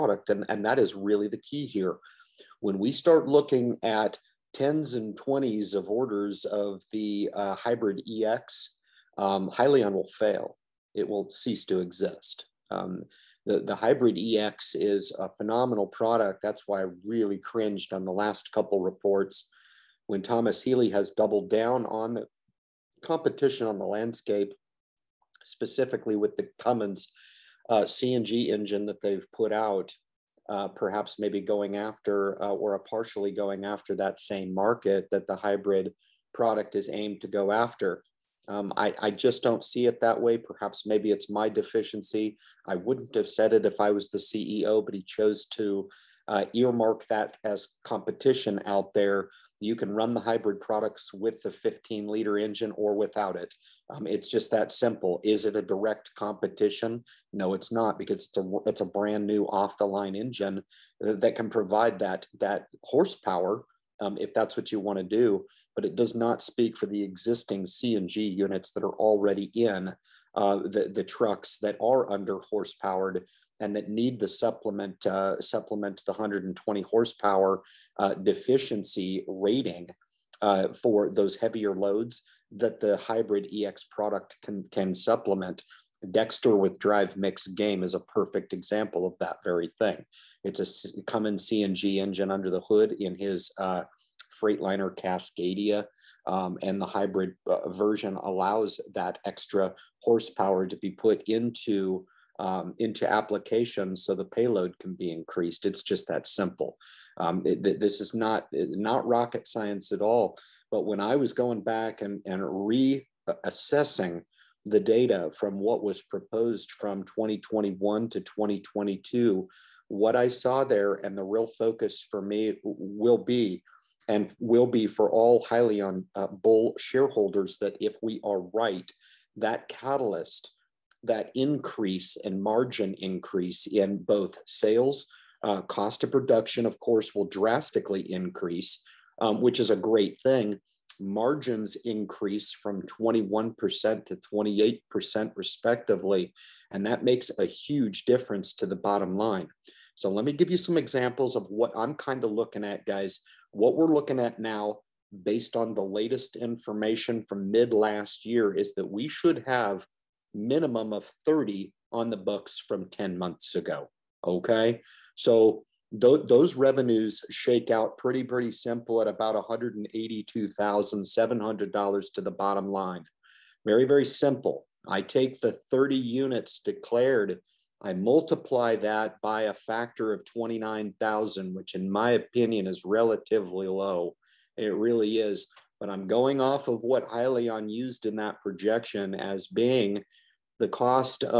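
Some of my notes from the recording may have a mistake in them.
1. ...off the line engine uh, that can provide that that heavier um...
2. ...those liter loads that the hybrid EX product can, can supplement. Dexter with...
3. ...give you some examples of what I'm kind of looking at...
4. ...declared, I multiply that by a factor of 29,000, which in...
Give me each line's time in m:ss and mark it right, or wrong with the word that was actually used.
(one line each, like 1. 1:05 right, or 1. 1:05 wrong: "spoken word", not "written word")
1. 0:59 wrong: "horsepower", not "heavier"
2. 1:21 wrong: "heavier", not "liter"
3. 2:30 right
4. 2:56 right.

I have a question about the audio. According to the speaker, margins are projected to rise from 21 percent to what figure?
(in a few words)
28%.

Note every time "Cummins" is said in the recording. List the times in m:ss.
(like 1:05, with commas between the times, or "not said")
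0:26, 1:31.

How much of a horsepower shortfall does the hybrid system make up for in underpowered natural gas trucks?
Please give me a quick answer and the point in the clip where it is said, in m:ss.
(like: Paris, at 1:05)
120 horsepower, at 1:16.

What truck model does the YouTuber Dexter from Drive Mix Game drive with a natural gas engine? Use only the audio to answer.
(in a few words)
Freightliner Cascadia.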